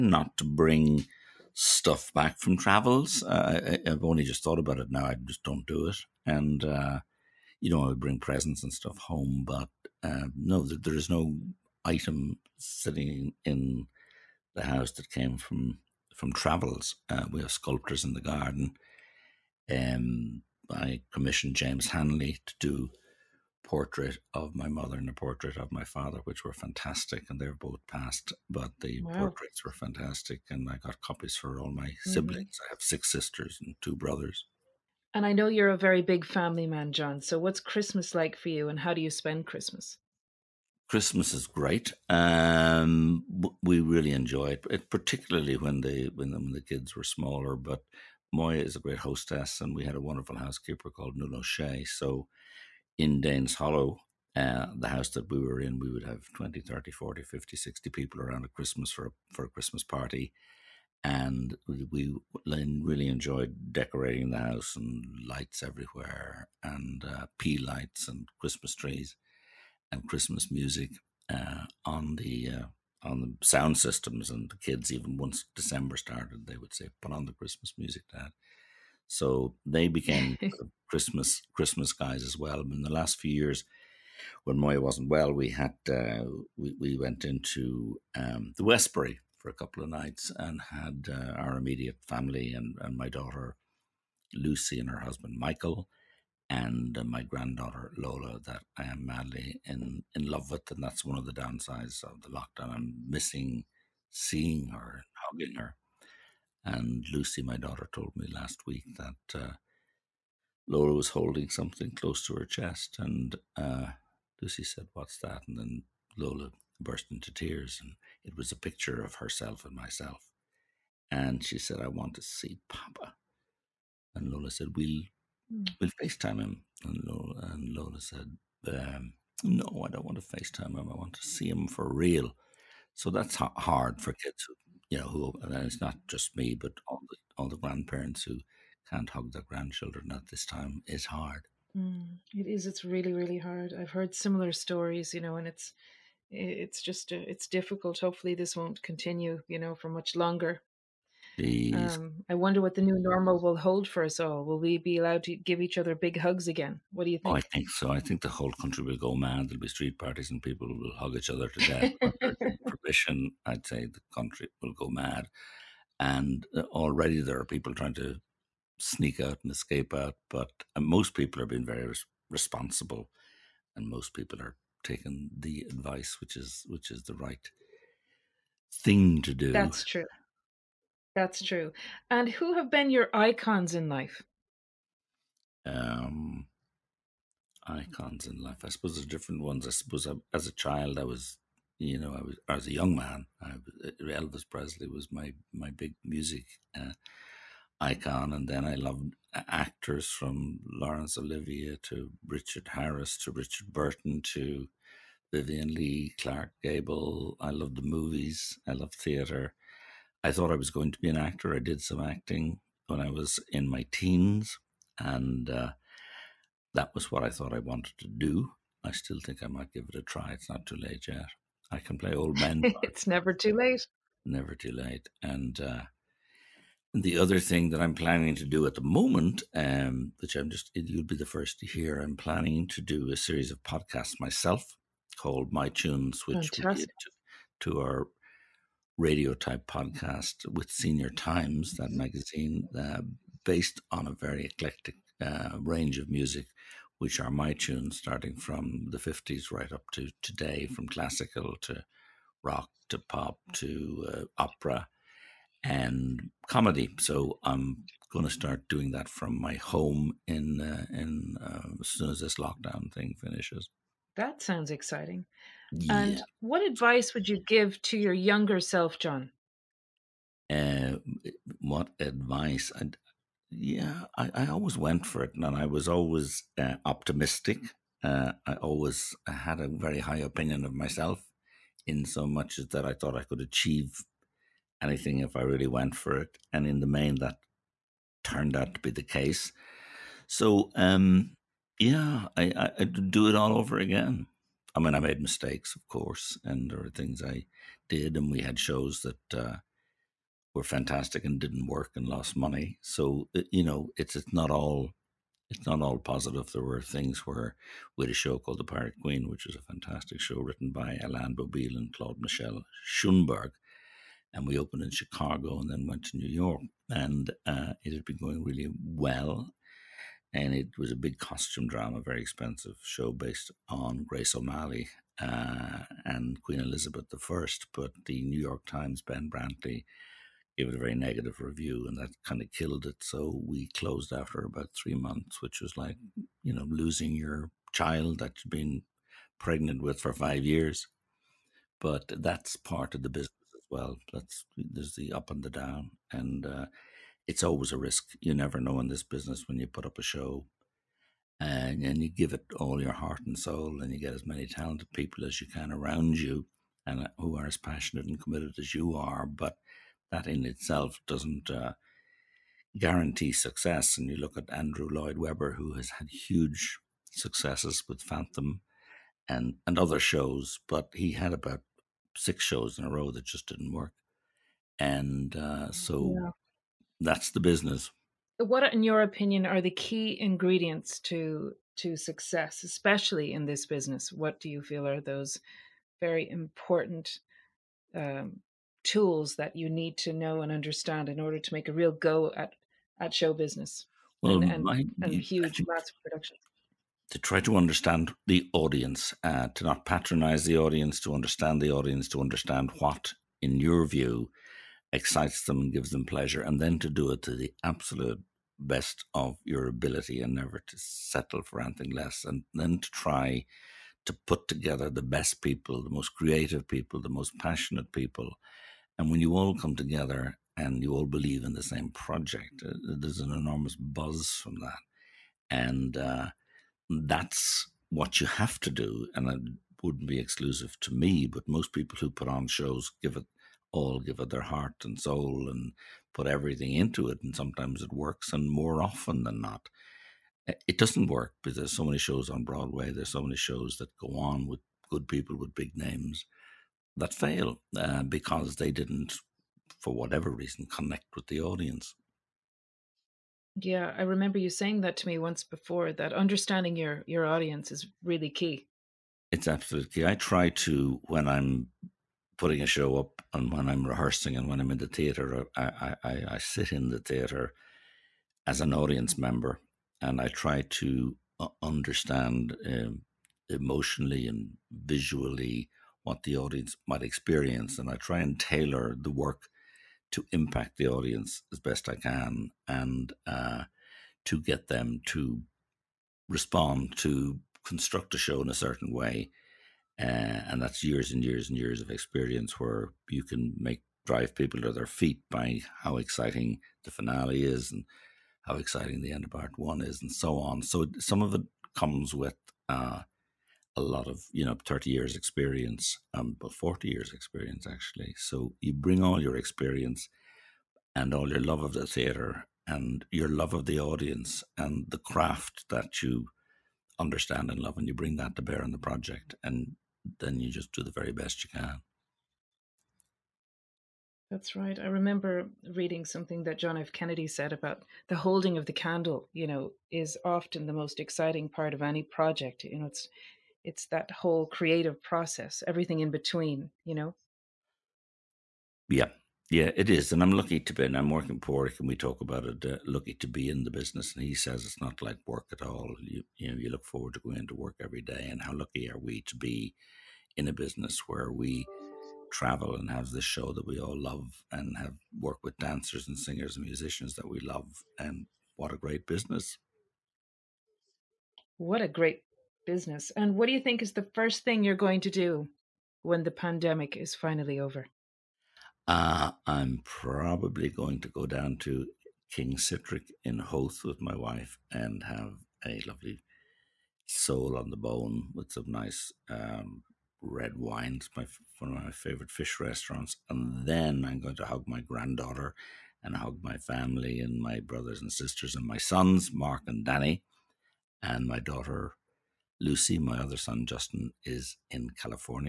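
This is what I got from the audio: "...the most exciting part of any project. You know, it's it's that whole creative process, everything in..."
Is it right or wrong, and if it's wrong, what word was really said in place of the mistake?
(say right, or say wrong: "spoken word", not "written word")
right.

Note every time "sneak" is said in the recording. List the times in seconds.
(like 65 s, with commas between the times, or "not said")
168 s.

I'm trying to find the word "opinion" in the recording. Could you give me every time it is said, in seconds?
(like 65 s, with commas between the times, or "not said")
280 s, 379 s.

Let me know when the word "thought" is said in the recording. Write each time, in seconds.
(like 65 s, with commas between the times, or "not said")
4 s, 210 s, 217 s, 282 s.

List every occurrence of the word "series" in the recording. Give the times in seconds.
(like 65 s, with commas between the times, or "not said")
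233 s.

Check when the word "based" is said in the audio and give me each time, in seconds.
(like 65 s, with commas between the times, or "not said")
243 s, 323 s.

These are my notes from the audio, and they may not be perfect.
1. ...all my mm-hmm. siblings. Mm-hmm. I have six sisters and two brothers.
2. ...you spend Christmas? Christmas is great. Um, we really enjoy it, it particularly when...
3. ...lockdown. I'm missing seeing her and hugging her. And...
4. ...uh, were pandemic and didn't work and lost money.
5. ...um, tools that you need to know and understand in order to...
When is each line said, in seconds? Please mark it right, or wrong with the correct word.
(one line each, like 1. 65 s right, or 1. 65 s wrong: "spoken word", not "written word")
1. 31 s right
2. 39 s right
3. 102 s right
4. 299 s wrong: "fantastic", not "pandemic"
5. 387 s right.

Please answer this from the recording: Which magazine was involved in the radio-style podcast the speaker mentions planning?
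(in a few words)
Senior Times.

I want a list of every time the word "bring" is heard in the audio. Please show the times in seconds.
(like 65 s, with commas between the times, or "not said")
0 s, 7 s, 508 s, 517 s.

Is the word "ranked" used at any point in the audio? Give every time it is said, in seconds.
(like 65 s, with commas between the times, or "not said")
not said.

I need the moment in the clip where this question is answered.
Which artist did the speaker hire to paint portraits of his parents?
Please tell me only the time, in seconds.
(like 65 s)
21 s.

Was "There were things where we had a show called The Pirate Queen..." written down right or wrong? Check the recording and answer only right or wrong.
right.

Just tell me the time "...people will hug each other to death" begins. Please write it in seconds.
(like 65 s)
160 s.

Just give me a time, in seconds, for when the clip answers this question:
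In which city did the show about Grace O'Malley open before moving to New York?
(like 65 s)
314 s.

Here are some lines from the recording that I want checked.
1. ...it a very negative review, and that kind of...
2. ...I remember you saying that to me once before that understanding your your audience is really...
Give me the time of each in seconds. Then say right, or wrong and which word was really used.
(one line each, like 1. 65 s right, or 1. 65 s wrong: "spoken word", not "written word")
1. 330 s right
2. 453 s right.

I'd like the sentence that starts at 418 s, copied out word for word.
And when you all come together and you all believe in the same project, uh, uh, there's an enormous buzz from that.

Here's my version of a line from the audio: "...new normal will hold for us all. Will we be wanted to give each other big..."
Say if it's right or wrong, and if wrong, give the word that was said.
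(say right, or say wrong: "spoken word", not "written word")
wrong: "allowed", not "wanted".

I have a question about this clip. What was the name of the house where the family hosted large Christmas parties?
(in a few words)
Danes Hollow.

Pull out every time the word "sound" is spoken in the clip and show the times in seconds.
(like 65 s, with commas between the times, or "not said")
73 s, 264 s.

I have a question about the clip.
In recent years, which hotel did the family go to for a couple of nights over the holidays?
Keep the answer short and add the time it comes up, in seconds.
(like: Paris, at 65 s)
The Westbury, at 88 s.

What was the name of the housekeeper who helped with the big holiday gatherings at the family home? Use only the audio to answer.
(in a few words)
Nuno Shea.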